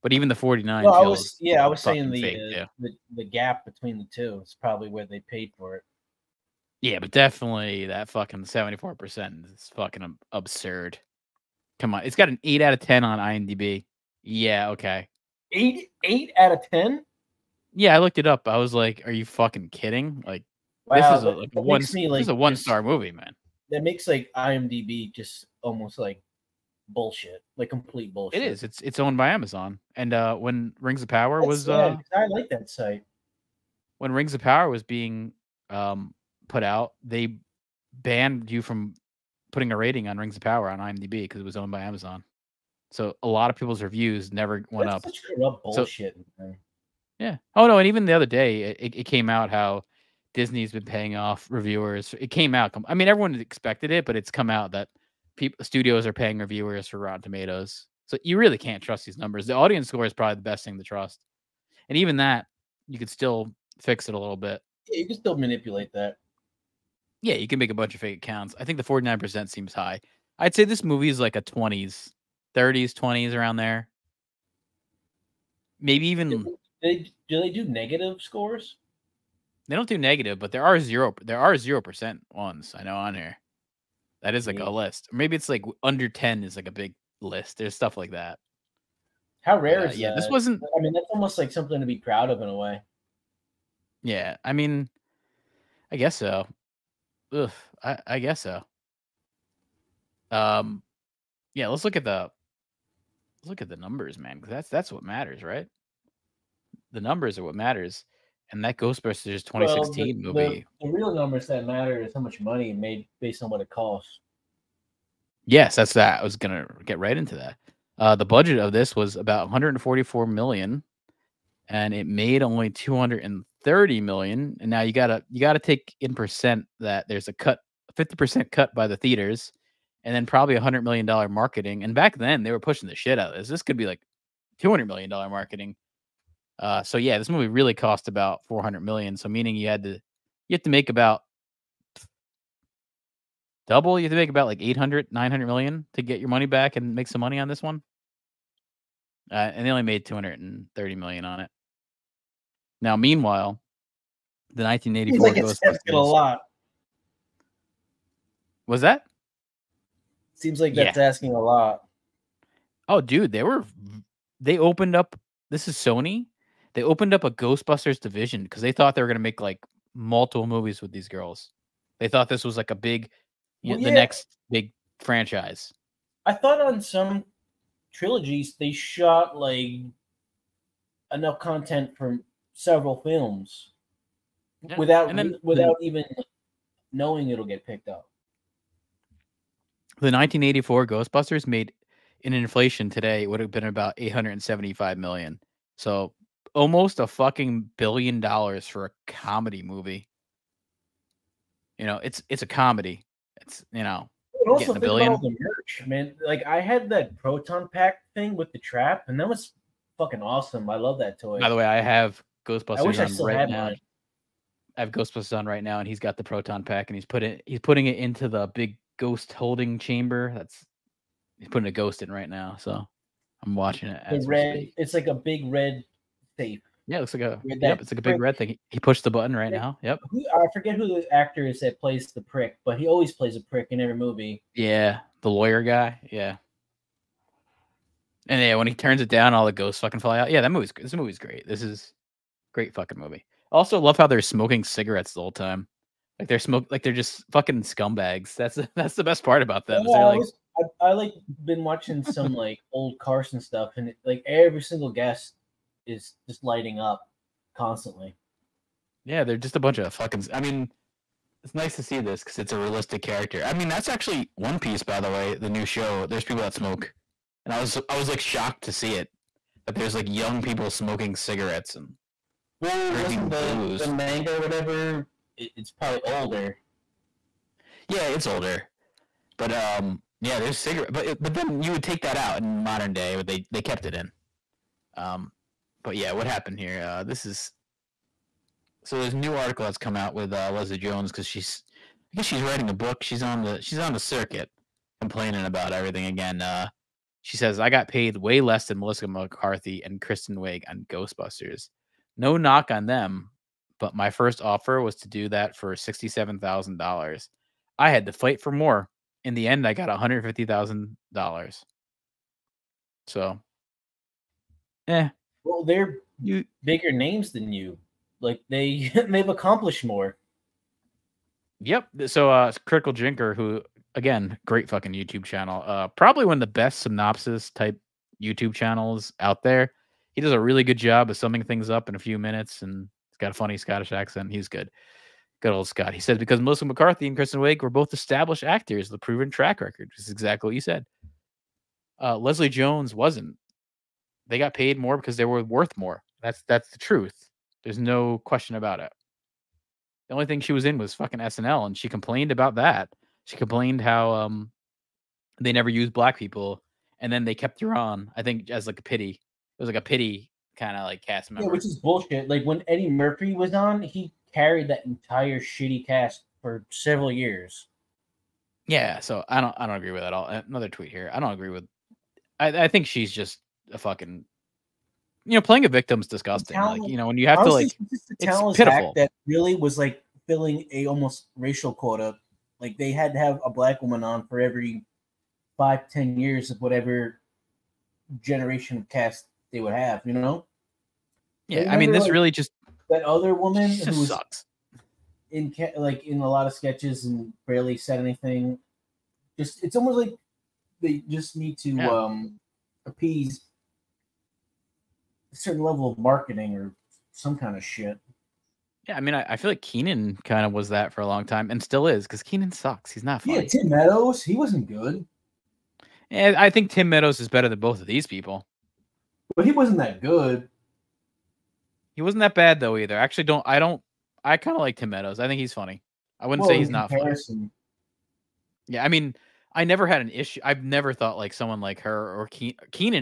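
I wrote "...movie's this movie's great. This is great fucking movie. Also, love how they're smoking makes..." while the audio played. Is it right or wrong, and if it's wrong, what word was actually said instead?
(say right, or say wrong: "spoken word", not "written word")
wrong: "cigarettes", not "makes".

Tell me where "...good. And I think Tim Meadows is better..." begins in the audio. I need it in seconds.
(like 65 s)
414 s.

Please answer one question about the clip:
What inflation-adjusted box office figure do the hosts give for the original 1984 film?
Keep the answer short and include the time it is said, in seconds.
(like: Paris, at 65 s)
875 million, at 193 s.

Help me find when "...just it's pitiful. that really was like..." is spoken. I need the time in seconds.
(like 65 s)
377 s.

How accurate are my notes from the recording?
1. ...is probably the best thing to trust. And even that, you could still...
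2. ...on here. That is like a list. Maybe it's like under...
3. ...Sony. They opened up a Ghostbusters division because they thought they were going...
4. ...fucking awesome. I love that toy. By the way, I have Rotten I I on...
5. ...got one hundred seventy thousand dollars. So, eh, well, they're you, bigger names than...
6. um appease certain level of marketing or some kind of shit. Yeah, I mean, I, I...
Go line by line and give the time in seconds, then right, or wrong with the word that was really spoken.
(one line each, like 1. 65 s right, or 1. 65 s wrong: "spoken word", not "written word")
1. 60 s right
2. 82 s right
3. 165 s right
4. 209 s wrong: "Ghostbusters", not "Rotten"
5. 309 s wrong: "fifty", not "seventy"
6. 401 s right.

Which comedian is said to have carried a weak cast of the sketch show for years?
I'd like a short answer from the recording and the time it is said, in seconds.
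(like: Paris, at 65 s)
Eddie Murphy, at 362 s.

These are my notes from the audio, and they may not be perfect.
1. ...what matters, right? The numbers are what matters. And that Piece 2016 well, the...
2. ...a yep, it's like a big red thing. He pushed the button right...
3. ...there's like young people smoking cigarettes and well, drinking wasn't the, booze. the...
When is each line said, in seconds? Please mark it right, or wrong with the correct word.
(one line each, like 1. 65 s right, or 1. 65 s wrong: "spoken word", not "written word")
1. 104 s wrong: "Ghostbusters", not "Piece"
2. 227 s right
3. 269 s right.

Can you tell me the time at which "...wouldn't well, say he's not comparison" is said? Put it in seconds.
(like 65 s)
426 s.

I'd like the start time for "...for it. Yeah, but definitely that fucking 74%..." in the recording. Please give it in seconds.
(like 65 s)
5 s.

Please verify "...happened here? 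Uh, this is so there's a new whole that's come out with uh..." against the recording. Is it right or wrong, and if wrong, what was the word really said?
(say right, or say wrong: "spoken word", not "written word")
wrong: "article", not "whole".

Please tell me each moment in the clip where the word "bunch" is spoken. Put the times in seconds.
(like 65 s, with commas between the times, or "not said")
67 s, 259 s.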